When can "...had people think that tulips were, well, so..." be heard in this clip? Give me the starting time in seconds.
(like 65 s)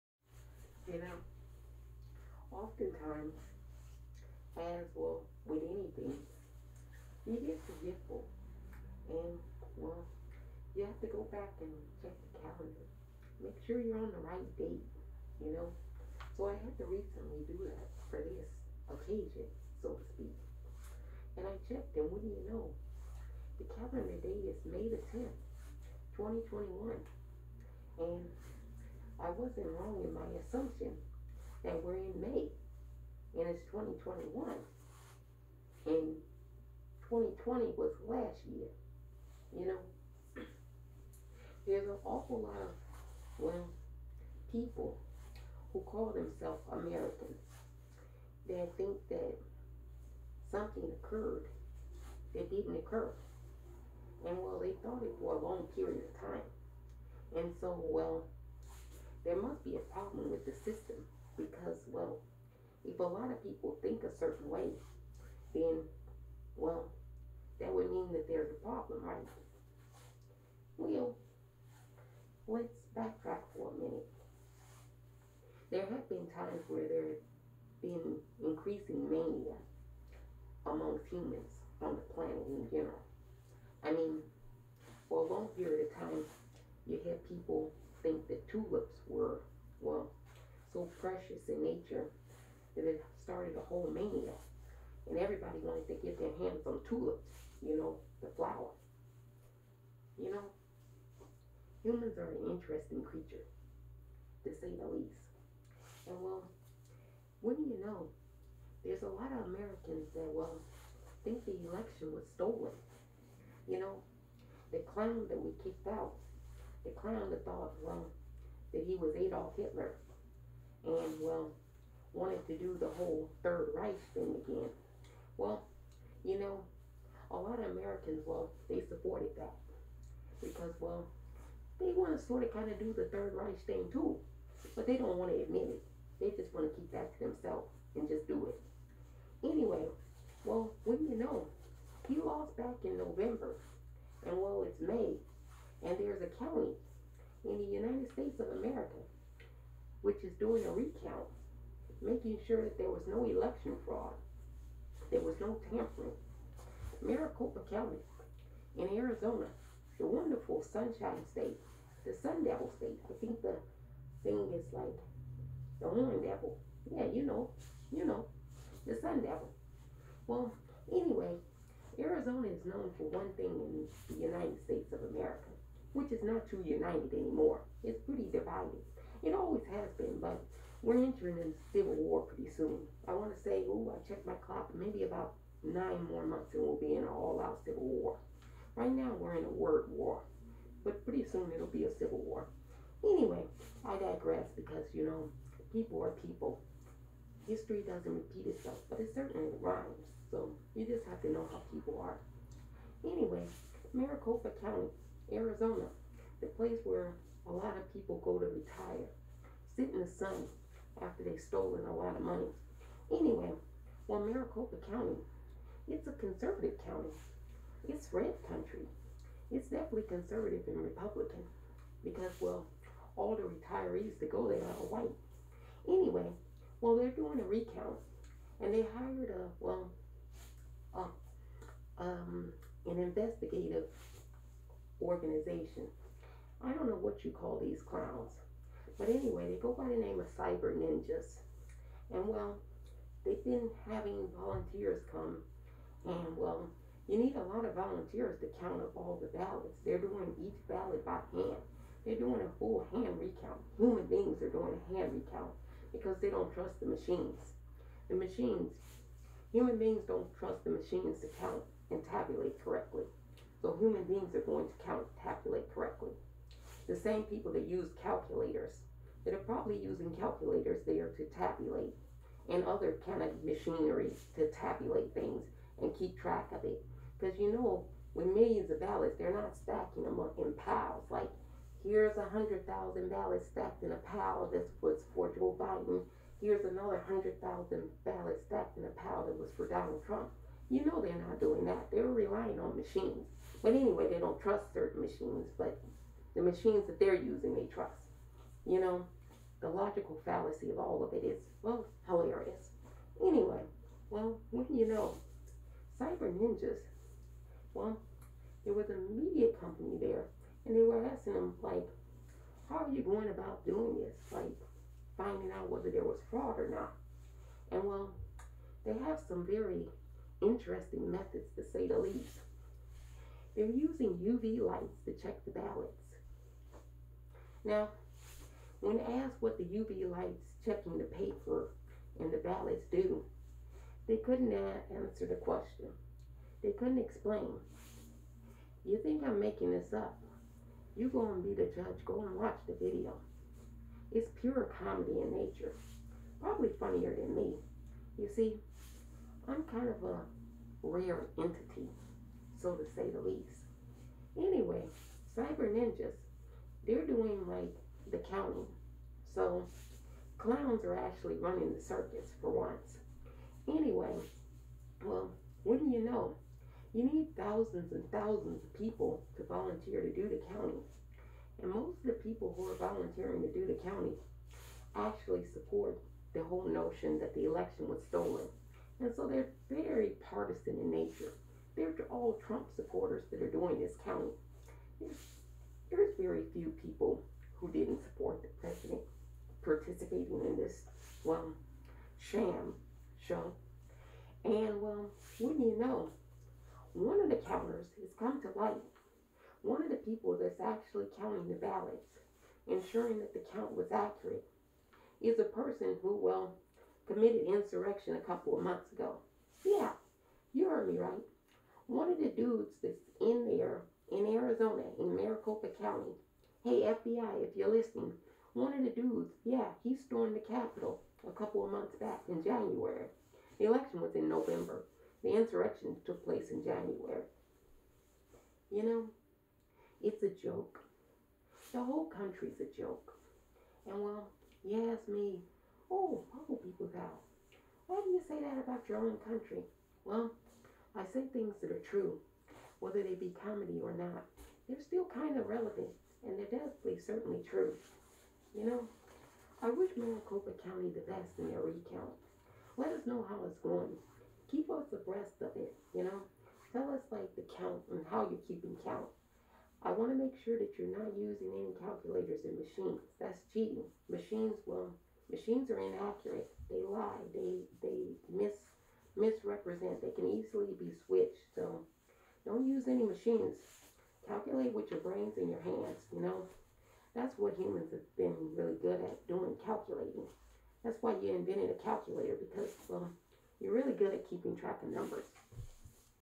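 87 s.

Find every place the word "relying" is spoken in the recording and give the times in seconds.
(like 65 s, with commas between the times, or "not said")
292 s.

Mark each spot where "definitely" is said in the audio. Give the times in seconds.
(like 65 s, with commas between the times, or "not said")
219 s, 446 s.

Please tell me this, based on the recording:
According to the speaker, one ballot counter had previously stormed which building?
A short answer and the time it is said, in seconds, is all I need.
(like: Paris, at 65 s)
The Capitol, at 420 s.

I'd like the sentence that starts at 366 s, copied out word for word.
You need thousands and thousands of people to volunteer to do the counting.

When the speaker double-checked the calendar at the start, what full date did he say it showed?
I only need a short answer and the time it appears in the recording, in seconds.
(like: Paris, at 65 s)
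May 10, 2021, at 24 s.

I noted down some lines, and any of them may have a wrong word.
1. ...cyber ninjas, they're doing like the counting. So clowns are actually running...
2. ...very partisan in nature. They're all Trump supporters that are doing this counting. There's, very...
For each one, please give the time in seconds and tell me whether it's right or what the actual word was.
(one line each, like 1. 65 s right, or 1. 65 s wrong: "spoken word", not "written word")
1. 355 s right
2. 379 s right.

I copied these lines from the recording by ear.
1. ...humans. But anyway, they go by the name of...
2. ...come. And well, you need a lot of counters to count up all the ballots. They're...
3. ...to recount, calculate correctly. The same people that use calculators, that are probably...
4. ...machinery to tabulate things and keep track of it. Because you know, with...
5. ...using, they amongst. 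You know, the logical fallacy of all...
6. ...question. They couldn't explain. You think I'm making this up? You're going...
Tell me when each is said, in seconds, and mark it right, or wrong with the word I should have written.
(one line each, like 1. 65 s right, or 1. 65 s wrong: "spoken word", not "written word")
1. 237 s wrong: "clowns", not "humans"
2. 245 s wrong: "volunteers", not "counters"
3. 264 s wrong: "count", not "recount"
4. 273 s right
5. 297 s wrong: "trust", not "amongst"
6. 335 s right.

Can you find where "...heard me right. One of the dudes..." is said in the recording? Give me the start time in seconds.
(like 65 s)
410 s.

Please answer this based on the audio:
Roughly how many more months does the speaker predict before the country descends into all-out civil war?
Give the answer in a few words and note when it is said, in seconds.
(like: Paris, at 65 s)
9, at 185 s.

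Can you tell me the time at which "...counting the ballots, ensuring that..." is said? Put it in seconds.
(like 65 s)
401 s.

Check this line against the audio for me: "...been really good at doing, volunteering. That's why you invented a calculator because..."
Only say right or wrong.
wrong.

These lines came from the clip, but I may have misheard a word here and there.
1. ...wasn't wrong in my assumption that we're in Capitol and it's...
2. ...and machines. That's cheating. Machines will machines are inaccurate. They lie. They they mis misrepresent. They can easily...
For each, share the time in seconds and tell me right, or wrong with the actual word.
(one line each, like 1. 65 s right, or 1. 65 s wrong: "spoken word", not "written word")
1. 29 s wrong: "May", not "Capitol"
2. 462 s right.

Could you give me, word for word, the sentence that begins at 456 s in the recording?
Tell us, like, the count and how you're keeping count.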